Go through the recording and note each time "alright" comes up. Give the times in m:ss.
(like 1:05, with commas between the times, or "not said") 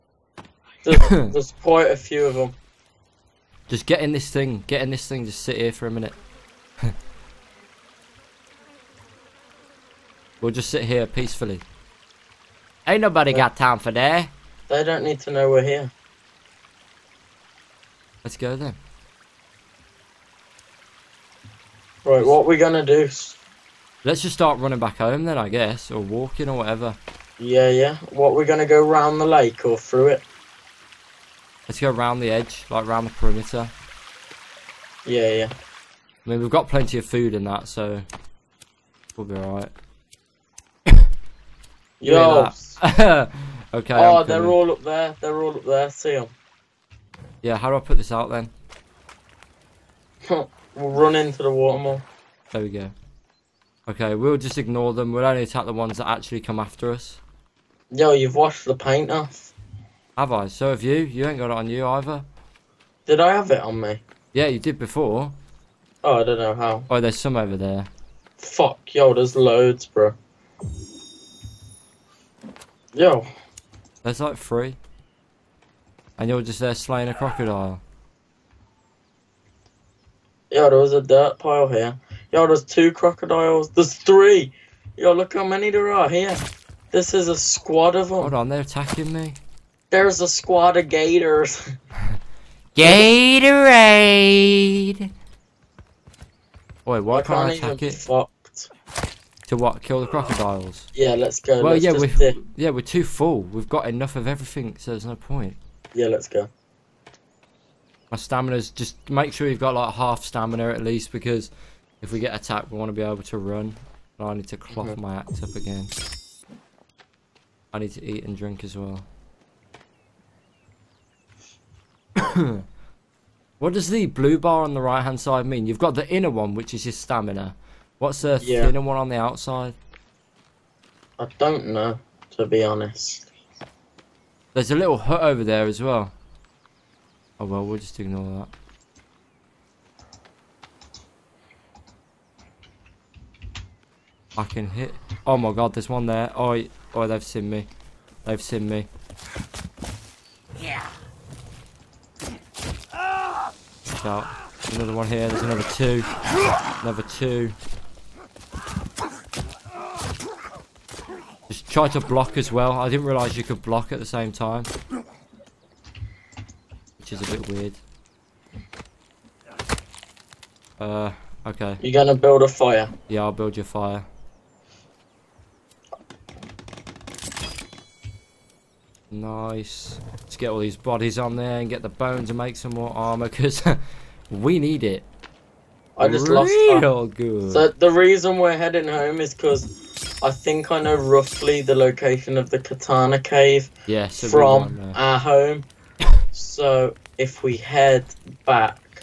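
0:39.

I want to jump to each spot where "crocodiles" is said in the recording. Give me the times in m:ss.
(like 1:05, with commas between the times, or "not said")
1:17, 1:22, 1:40.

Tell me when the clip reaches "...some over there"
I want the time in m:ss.
1:07.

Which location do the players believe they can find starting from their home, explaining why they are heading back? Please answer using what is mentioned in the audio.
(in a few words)
Katana Cave.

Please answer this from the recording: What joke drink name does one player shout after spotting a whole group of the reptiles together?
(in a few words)
Gatorade.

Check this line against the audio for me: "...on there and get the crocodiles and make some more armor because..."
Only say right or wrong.
wrong.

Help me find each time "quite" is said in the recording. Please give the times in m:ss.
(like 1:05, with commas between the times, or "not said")
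0:01.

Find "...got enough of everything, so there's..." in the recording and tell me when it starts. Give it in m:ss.
1:43.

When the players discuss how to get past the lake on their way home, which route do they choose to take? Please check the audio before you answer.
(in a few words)
Round the edge.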